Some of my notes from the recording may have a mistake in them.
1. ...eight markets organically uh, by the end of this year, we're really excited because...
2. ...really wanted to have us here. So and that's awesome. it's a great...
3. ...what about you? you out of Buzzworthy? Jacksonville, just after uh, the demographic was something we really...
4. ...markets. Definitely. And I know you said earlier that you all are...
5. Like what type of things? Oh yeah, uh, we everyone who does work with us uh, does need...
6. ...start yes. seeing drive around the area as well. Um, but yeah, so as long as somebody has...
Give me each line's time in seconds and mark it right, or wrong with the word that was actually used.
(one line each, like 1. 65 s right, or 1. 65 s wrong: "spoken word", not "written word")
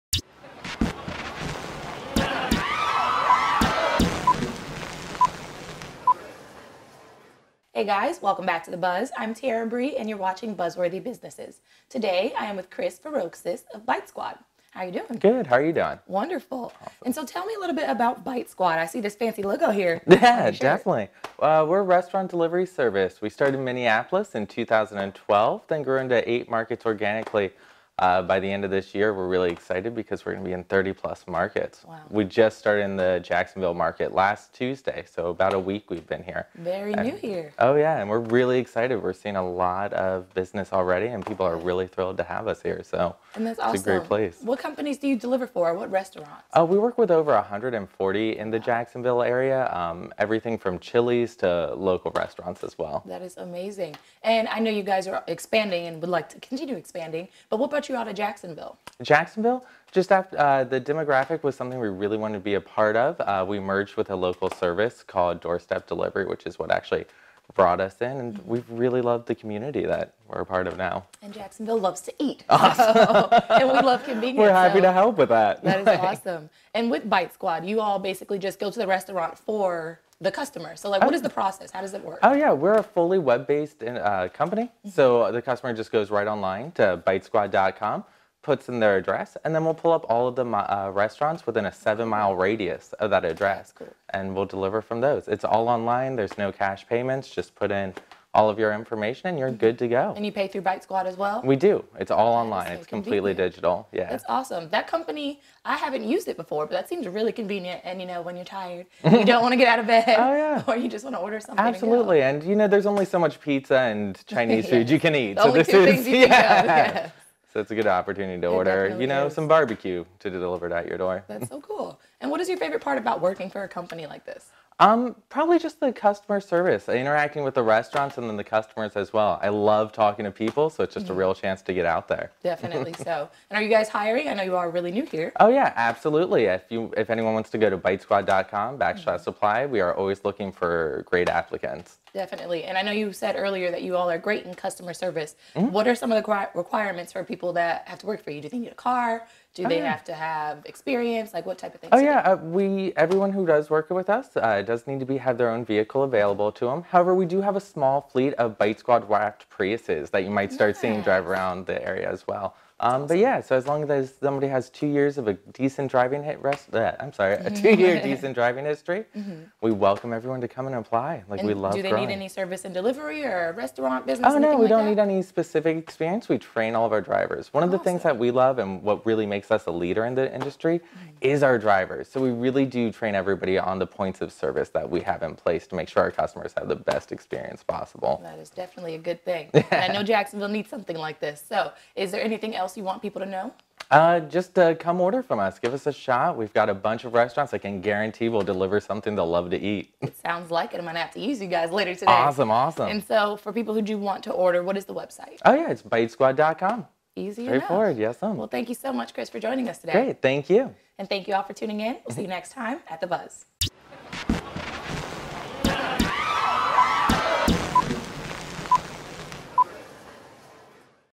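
1. 26 s right
2. 41 s wrong: "thrilled", not "wanted"
3. 57 s wrong: "Jacksonville", not "Buzzworthy"
4. 141 s wrong: "applicants", not "markets"
5. 151 s right
6. 160 s right.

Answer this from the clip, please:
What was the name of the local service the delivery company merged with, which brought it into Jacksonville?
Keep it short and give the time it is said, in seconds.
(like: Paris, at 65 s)
Doorstep Delivery, at 65 s.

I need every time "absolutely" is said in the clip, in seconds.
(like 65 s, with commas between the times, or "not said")
111 s, 135 s.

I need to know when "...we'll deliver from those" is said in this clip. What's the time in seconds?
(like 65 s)
94 s.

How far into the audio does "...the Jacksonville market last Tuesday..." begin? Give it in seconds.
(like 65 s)
32 s.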